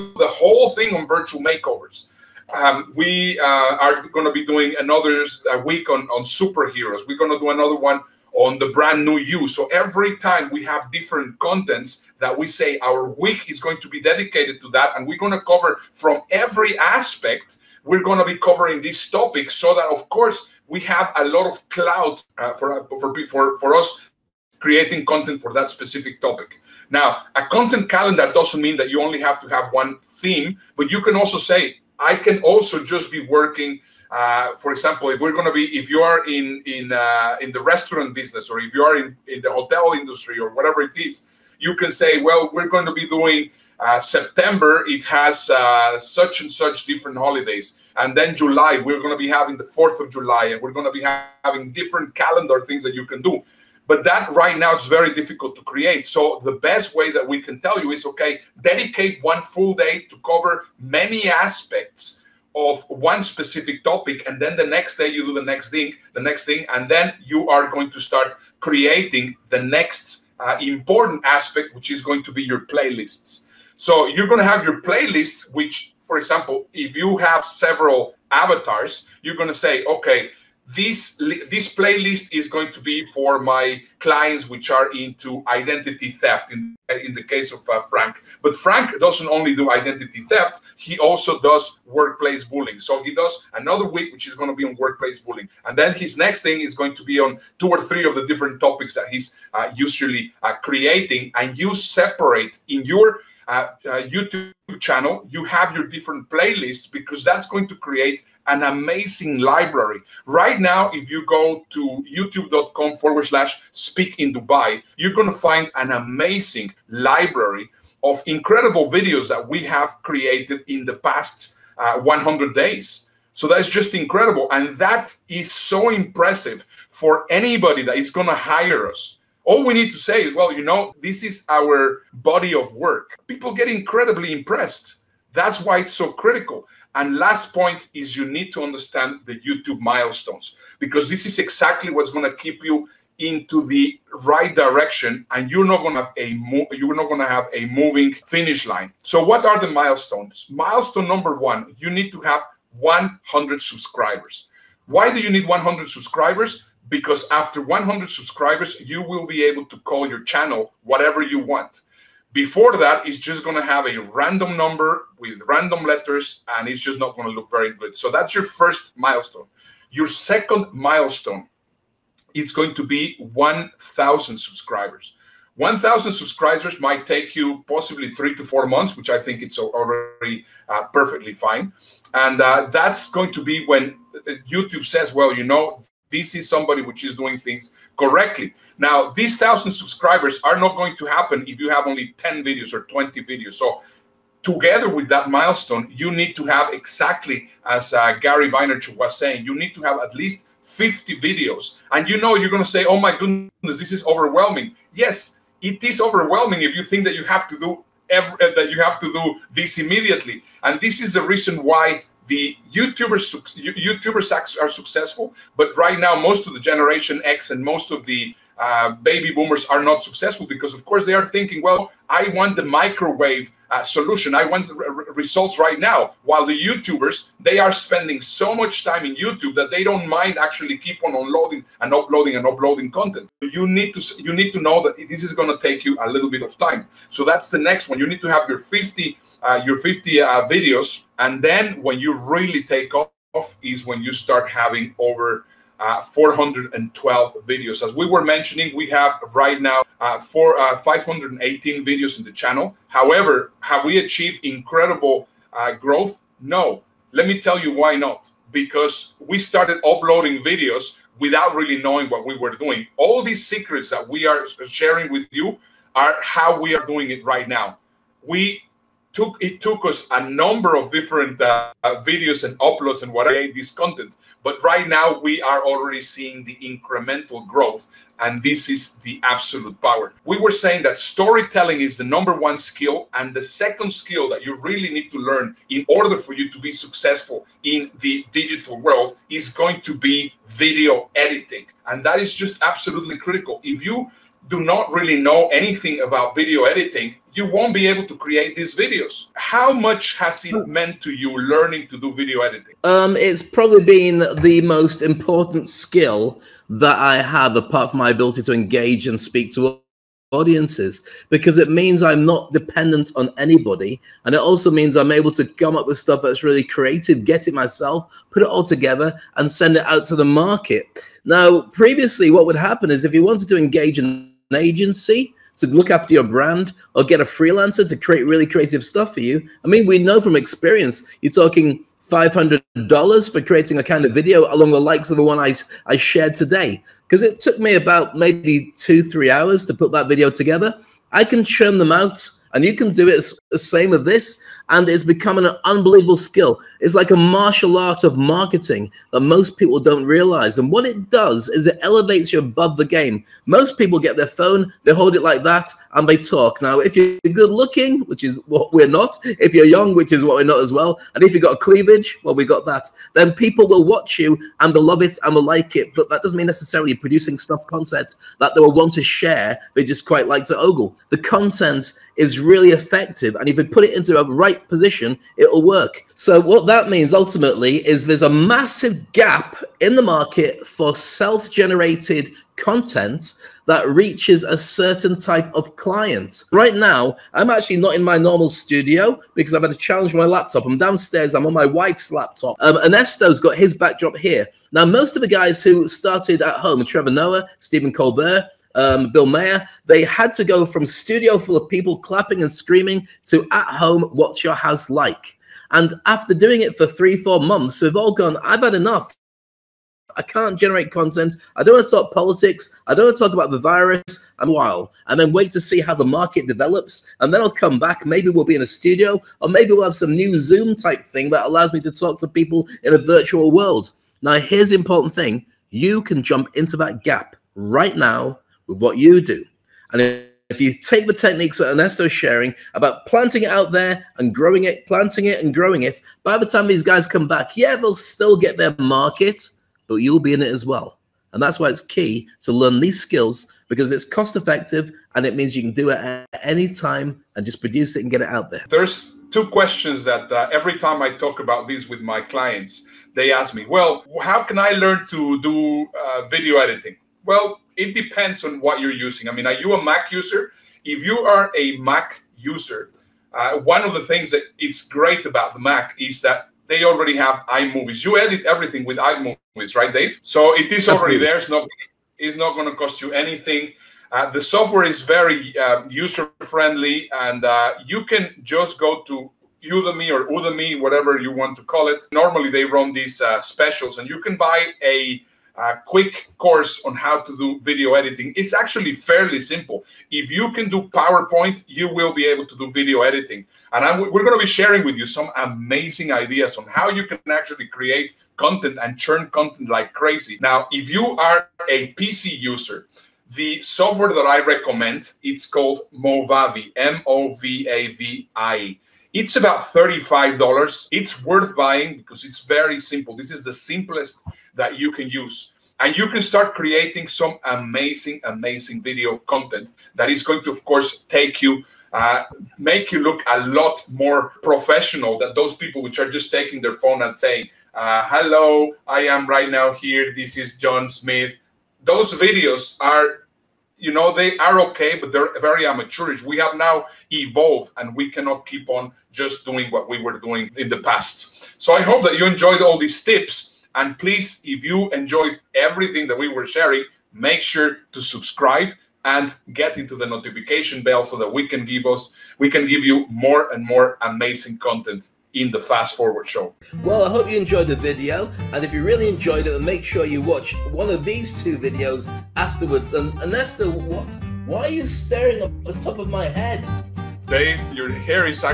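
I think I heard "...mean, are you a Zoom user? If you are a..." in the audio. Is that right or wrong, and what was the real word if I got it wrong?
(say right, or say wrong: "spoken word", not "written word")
wrong: "Mac", not "Zoom".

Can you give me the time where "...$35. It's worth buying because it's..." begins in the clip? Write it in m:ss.
8:29.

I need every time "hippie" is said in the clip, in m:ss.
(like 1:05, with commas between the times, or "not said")
not said.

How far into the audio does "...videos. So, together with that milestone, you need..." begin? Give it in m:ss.
3:13.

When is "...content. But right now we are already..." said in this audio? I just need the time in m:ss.
4:33.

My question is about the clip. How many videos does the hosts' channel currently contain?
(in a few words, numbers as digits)
518.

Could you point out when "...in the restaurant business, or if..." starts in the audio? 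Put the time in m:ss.
0:37.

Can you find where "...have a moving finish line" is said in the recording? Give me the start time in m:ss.
2:27.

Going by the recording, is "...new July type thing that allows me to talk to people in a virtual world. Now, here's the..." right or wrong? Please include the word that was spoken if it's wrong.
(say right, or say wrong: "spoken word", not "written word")
wrong: "Zoom", not "July".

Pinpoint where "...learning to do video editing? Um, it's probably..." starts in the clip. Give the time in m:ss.
5:01.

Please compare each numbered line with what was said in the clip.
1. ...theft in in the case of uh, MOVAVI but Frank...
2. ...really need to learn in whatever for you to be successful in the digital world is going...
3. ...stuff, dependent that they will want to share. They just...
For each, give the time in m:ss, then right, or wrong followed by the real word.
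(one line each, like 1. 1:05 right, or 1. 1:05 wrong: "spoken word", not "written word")
1. 1:26 wrong: "Frank", not "MOVAVI"
2. 4:44 wrong: "order", not "whatever"
3. 6:07 wrong: "content", not "dependent".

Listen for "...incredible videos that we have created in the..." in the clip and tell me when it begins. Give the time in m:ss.
1:58.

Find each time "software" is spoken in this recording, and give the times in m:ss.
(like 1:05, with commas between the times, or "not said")
7:54, 8:23.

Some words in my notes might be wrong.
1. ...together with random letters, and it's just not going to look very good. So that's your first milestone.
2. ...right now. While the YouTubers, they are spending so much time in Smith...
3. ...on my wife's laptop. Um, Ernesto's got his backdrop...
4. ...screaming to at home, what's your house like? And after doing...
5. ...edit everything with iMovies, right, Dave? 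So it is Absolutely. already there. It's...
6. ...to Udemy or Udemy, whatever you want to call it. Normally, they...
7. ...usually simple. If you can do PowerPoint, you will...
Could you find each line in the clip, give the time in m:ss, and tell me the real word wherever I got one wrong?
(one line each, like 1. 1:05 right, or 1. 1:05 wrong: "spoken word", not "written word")
1. 2:44 wrong: "number", not "together"
2. 3:45 wrong: "YouTube", not "Smith"
3. 6:31 right
4. 6:42 right
5. 7:48 right
6. 7:59 right
7. 8:08 wrong: "fairly", not "usually".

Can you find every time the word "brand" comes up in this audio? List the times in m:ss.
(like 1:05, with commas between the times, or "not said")
0:08, 5:26.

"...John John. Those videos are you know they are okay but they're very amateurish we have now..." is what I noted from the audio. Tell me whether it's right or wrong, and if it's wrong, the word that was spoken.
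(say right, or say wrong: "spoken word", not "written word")
wrong: "Smith", not "John".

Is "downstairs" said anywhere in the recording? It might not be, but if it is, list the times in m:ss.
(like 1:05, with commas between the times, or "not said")
6:30.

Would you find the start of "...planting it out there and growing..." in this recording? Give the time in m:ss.
7:13.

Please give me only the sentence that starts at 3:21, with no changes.
And you know, you're going to say, oh my goodness, this is overwhelming.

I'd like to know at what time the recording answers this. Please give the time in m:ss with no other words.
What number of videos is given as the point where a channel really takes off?
4:06.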